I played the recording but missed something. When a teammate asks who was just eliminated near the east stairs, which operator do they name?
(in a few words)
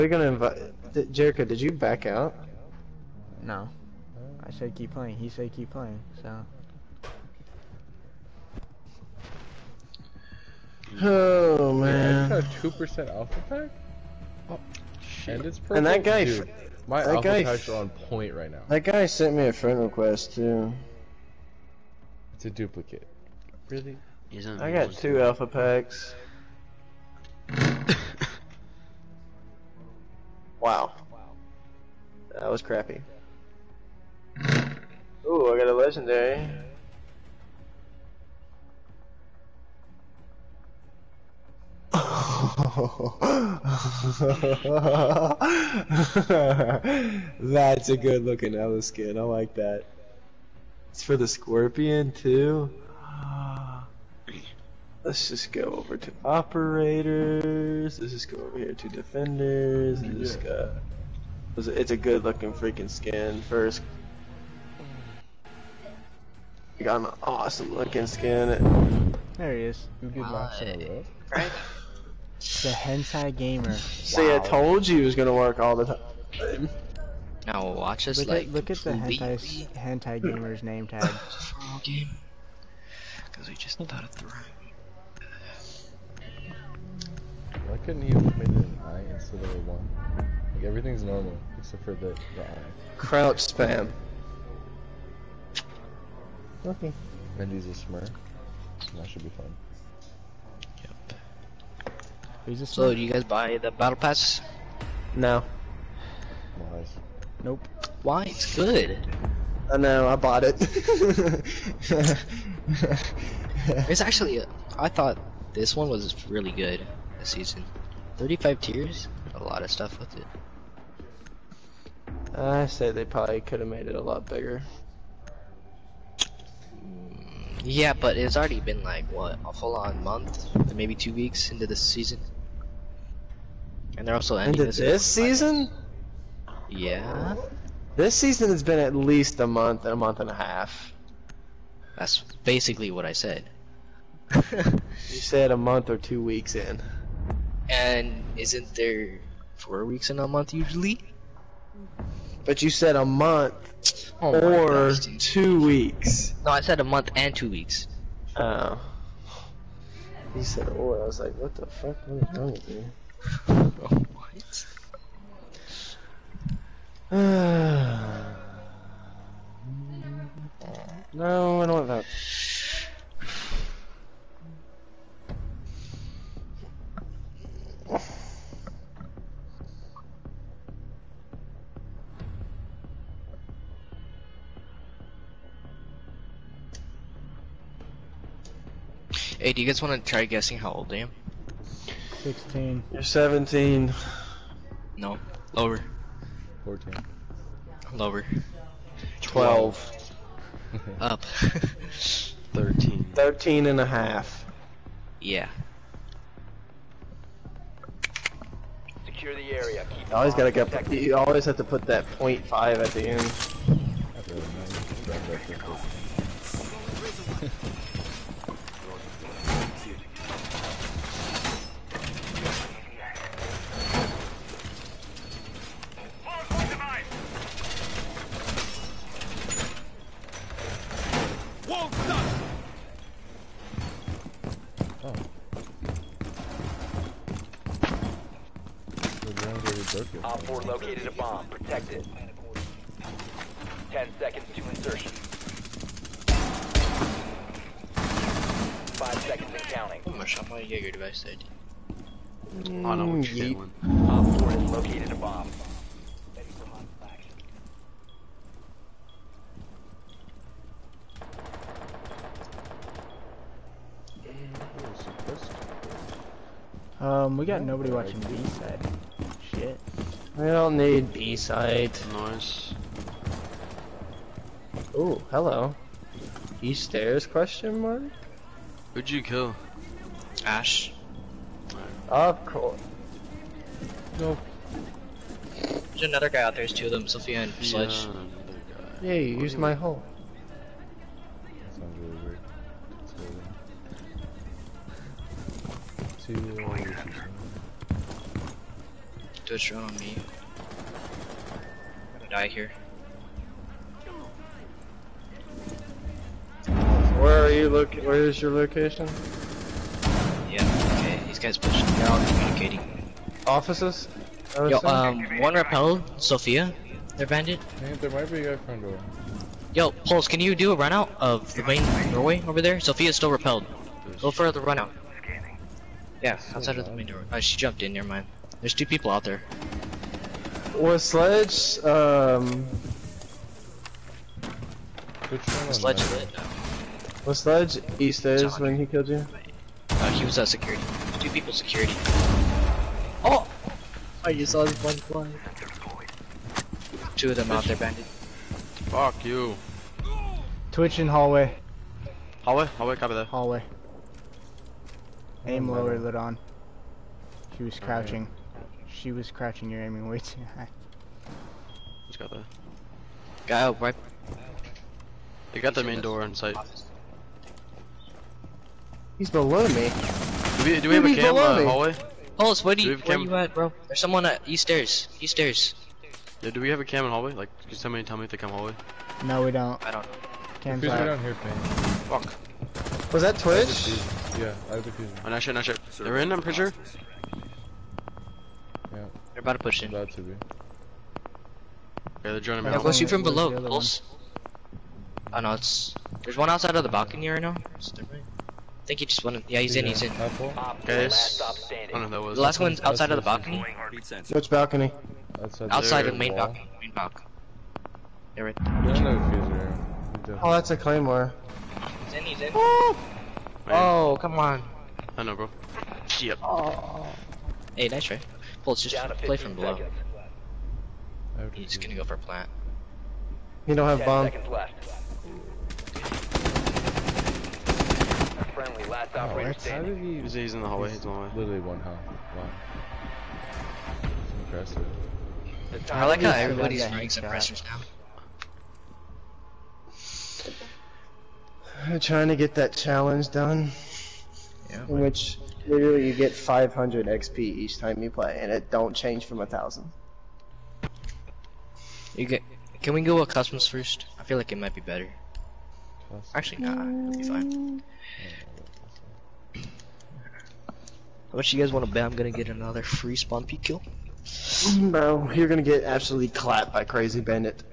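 Ash.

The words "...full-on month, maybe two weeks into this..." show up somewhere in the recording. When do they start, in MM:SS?
02:09.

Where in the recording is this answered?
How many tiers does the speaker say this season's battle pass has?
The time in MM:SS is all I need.
01:58.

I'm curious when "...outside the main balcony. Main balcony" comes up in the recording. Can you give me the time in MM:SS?
06:45.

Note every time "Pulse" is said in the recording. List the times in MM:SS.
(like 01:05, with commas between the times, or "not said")
05:19, 06:12, 06:33.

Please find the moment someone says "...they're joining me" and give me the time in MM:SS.
06:32.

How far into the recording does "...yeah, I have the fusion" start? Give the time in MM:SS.
06:24.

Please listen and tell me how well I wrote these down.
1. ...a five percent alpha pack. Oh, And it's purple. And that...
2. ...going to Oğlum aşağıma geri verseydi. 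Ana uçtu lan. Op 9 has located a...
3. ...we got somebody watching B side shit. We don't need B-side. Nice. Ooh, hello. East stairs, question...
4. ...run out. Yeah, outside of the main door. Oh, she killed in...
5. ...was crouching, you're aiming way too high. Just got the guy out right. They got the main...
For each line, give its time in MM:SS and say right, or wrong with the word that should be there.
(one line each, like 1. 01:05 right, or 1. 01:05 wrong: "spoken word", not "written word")
1. 00:12 wrong: "two", not "five"
2. 04:10 wrong: "4", not "9"
3. 04:27 wrong: "nobody", not "somebody"
4. 05:24 wrong: "jumped", not "killed"
5. 05:59 right.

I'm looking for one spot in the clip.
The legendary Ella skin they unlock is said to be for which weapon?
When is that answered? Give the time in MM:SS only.
00:51.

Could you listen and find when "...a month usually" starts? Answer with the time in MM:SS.
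02:30.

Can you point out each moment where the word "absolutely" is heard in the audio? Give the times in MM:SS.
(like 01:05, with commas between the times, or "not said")
07:45.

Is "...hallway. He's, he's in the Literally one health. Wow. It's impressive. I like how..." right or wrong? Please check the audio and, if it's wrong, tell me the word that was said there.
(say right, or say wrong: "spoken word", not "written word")
right.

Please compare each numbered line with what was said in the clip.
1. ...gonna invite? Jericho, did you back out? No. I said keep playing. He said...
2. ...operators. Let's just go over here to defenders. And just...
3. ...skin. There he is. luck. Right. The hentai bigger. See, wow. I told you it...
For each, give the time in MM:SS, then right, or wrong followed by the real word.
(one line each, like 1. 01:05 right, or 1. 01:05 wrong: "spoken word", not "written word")
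1. 00:00 right
2. 00:56 right
3. 01:08 wrong: "gamer", not "bigger".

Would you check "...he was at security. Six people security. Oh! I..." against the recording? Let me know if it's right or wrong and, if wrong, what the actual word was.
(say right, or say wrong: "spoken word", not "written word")
wrong: "Two", not "Six".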